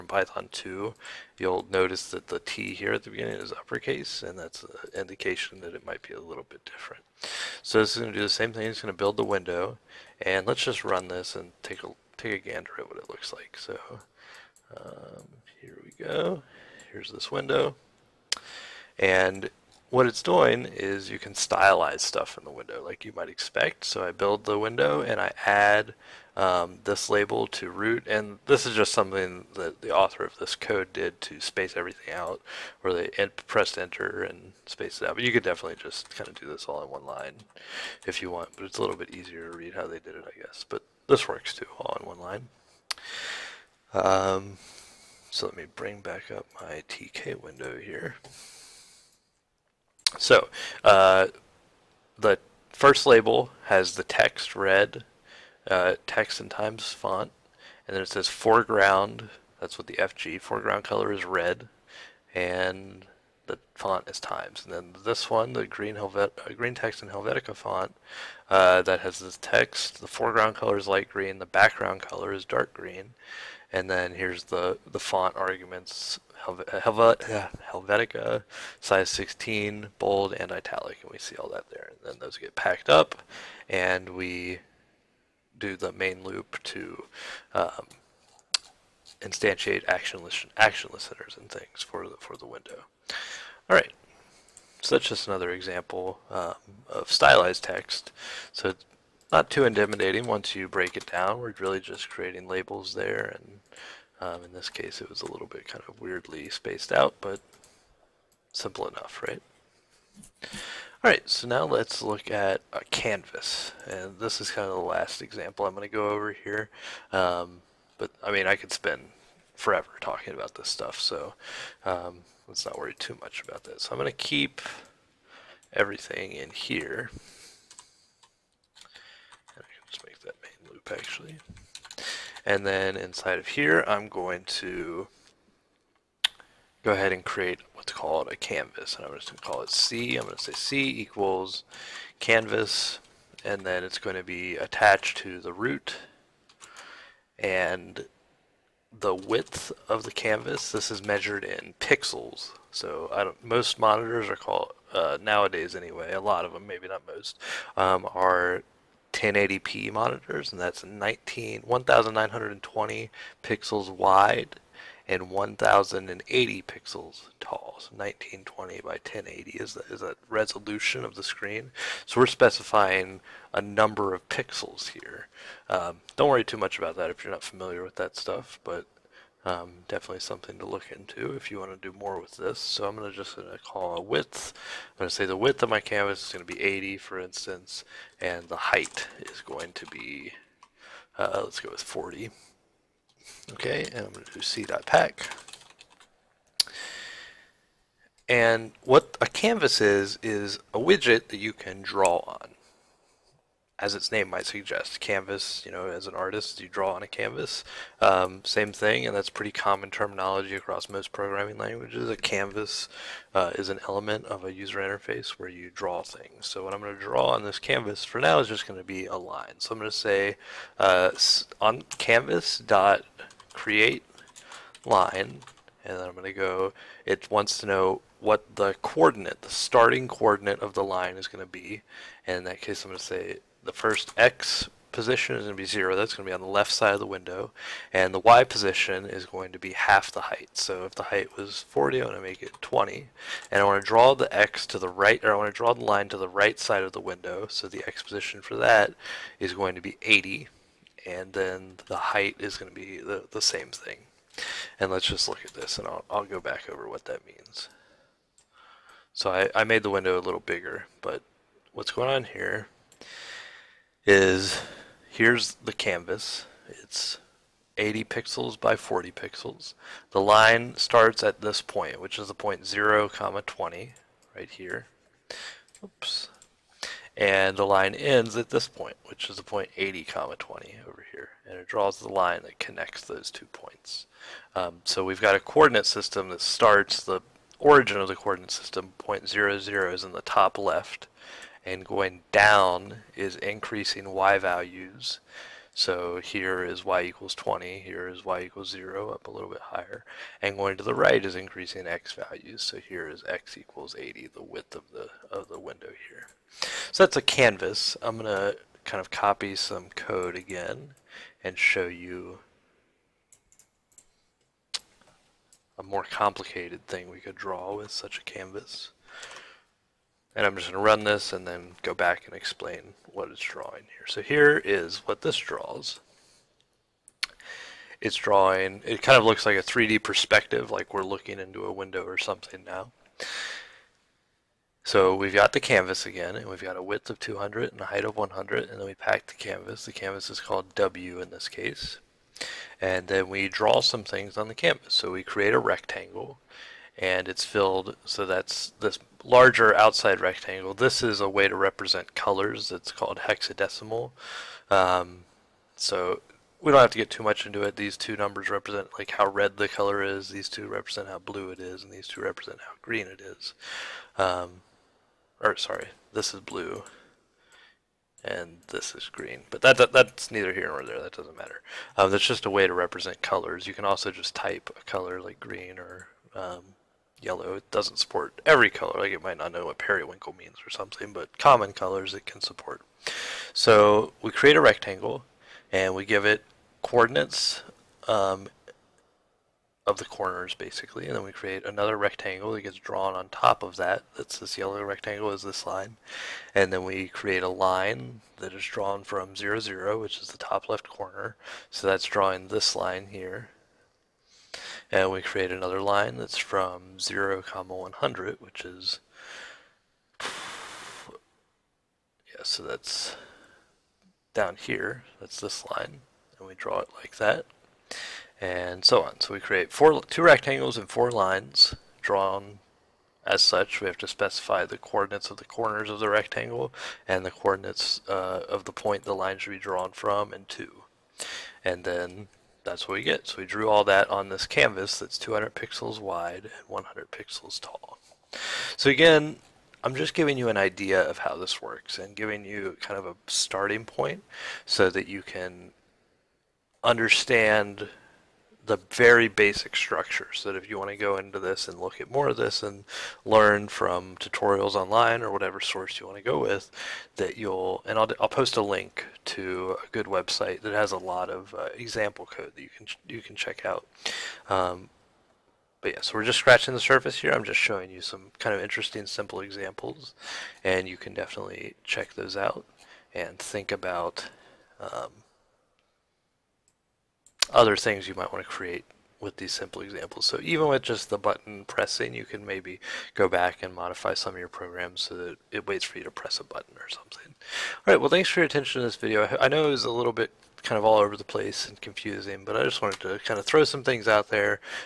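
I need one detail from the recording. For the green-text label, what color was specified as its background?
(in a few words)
dark green.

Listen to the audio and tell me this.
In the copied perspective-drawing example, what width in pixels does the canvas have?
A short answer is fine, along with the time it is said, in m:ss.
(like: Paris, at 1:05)
200, at 5:36.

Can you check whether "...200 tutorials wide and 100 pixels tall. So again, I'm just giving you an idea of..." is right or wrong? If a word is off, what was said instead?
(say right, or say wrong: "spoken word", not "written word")
wrong: "pixels", not "tutorials".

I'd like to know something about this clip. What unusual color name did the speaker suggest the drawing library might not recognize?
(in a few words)
periwinkle.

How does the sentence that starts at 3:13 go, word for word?
Okay, and I'm going to do c.pack.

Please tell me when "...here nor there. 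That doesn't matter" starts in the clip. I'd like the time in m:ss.
6:10.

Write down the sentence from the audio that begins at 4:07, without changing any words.
So the X position for that is going to be 80.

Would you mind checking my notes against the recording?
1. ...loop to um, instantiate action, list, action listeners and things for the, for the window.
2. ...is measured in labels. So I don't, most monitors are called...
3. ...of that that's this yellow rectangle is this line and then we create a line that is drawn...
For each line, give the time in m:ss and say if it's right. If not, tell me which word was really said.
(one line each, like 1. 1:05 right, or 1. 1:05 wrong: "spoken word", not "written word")
1. 1:26 right
2. 2:30 wrong: "pixels", not "labels"
3. 6:33 right.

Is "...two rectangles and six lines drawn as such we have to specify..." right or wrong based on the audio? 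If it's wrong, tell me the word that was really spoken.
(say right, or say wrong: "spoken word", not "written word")
wrong: "four", not "six".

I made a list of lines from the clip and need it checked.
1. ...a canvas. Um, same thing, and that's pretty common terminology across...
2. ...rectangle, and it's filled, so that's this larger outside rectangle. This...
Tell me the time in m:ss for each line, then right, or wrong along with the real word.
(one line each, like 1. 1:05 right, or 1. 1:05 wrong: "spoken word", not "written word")
1. 3:27 right
2. 5:45 right.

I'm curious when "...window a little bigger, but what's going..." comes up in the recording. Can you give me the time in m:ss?
4:19.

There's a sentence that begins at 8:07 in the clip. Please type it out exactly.
All right, well, thanks for your attention to this video.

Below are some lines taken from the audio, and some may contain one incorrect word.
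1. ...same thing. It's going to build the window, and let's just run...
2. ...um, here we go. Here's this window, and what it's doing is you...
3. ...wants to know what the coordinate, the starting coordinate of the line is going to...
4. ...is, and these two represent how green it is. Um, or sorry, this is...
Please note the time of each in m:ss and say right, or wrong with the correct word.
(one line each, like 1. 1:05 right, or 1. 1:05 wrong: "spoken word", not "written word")
1. 0:08 right
2. 0:14 right
3. 3:47 right
4. 6:01 right.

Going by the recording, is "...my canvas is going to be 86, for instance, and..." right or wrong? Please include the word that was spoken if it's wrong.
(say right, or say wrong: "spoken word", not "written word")
wrong: "80", not "86".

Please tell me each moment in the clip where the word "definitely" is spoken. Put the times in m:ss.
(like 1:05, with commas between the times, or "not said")
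0:35, 2:59, 7:51.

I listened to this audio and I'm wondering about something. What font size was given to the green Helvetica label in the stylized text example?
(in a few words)
16.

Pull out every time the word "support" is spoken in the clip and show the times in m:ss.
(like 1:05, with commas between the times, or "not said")
6:17, 6:22.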